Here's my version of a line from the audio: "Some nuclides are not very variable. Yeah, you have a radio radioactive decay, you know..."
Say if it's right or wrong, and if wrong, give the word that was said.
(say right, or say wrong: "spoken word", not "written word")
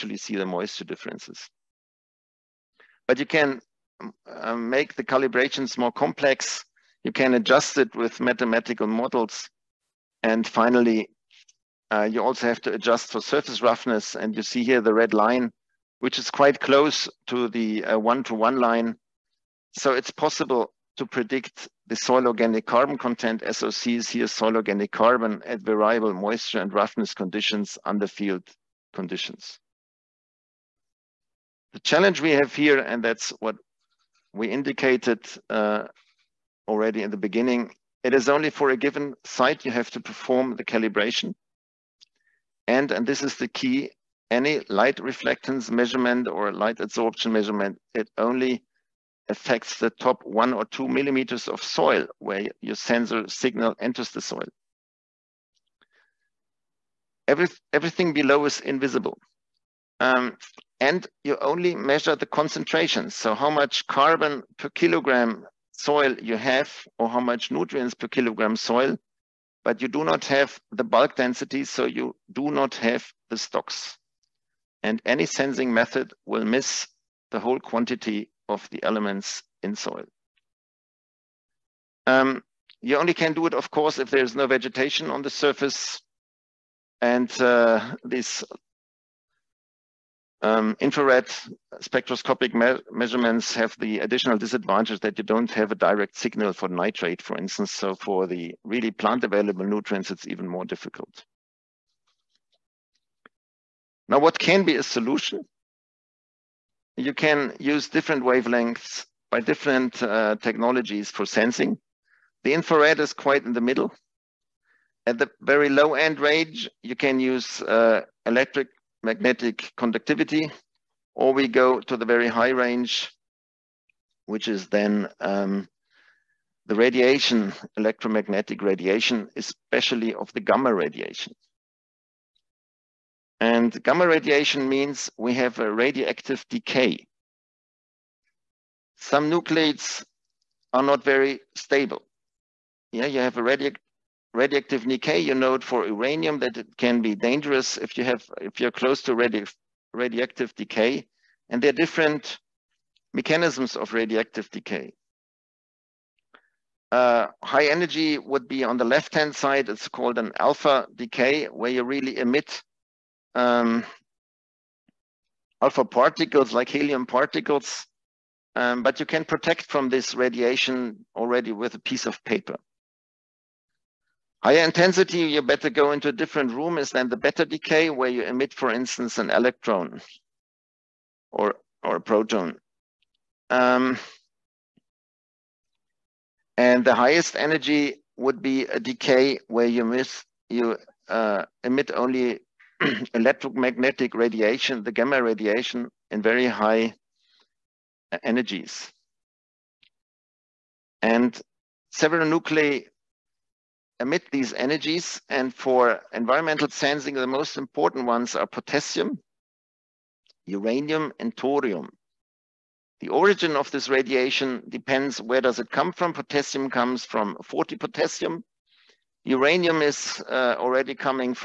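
wrong: "stable", not "variable".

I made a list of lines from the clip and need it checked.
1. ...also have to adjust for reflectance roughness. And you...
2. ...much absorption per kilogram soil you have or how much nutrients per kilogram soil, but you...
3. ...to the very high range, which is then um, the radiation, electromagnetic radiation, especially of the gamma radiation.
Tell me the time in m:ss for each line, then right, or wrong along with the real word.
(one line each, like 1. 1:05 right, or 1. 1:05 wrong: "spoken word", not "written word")
1. 0:12 wrong: "surface", not "reflectance"
2. 1:03 wrong: "carbon", not "absorption"
3. 2:01 right.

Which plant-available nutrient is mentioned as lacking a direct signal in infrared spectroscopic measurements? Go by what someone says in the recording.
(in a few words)
Nitrate.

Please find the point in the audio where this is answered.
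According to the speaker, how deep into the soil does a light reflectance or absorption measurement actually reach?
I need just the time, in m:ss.
0:50.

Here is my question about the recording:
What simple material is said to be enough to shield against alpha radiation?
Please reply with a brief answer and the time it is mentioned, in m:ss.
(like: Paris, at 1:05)
A piece of paper, at 2:51.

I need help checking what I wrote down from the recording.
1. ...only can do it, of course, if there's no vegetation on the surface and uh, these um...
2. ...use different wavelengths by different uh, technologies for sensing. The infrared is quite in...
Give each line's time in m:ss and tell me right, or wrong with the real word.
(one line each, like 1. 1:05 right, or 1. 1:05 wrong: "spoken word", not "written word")
1. 1:22 right
2. 1:47 right.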